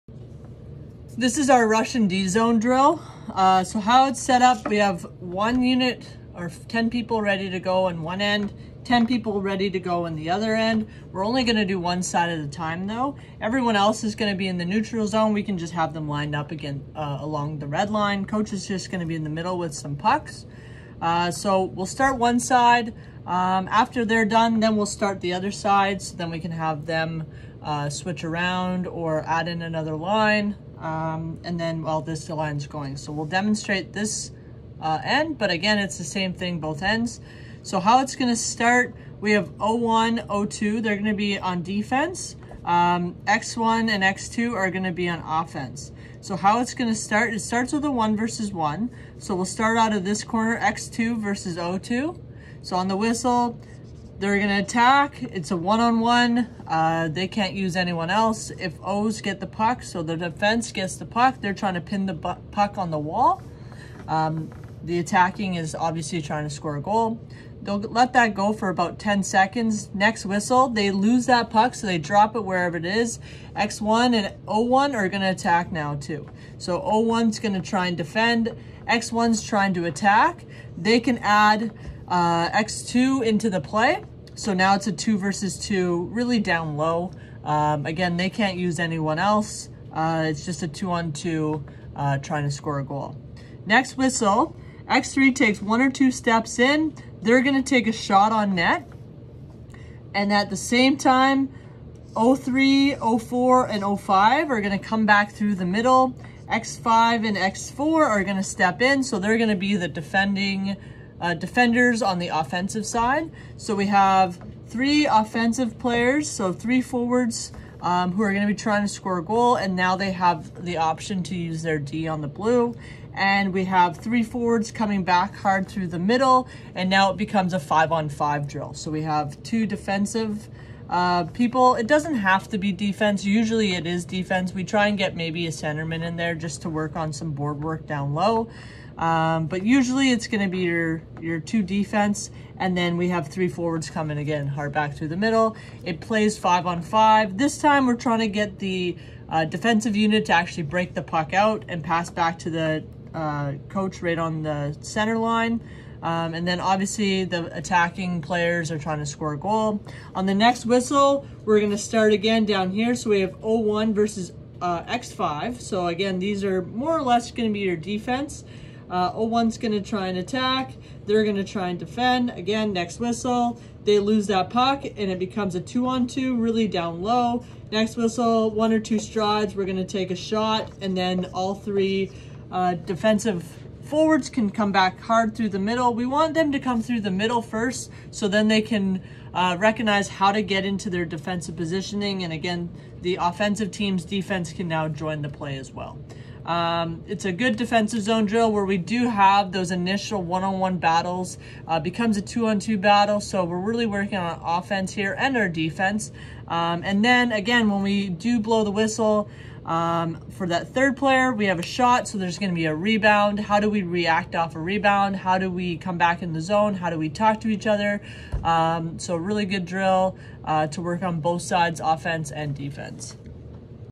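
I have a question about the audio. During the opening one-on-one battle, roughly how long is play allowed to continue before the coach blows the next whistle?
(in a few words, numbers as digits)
10 seconds.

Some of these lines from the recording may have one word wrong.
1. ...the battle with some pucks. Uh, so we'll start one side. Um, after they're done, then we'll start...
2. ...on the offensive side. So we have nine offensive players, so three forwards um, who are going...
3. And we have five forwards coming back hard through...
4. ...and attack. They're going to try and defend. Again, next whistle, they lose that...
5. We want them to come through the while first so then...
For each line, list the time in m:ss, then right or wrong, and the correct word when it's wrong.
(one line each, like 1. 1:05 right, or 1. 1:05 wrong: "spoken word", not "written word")
1. 0:19 wrong: "middle", not "battle"
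2. 1:52 wrong: "three", not "nine"
3. 2:03 wrong: "three", not "five"
4. 2:50 right
5. 3:05 wrong: "middle", not "while".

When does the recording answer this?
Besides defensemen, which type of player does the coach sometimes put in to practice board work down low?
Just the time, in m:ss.
2:15.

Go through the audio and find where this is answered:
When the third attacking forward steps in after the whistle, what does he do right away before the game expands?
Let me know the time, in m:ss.
1:37.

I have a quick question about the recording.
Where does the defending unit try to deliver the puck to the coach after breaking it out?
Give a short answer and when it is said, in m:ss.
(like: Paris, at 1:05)
Center line, at 2:34.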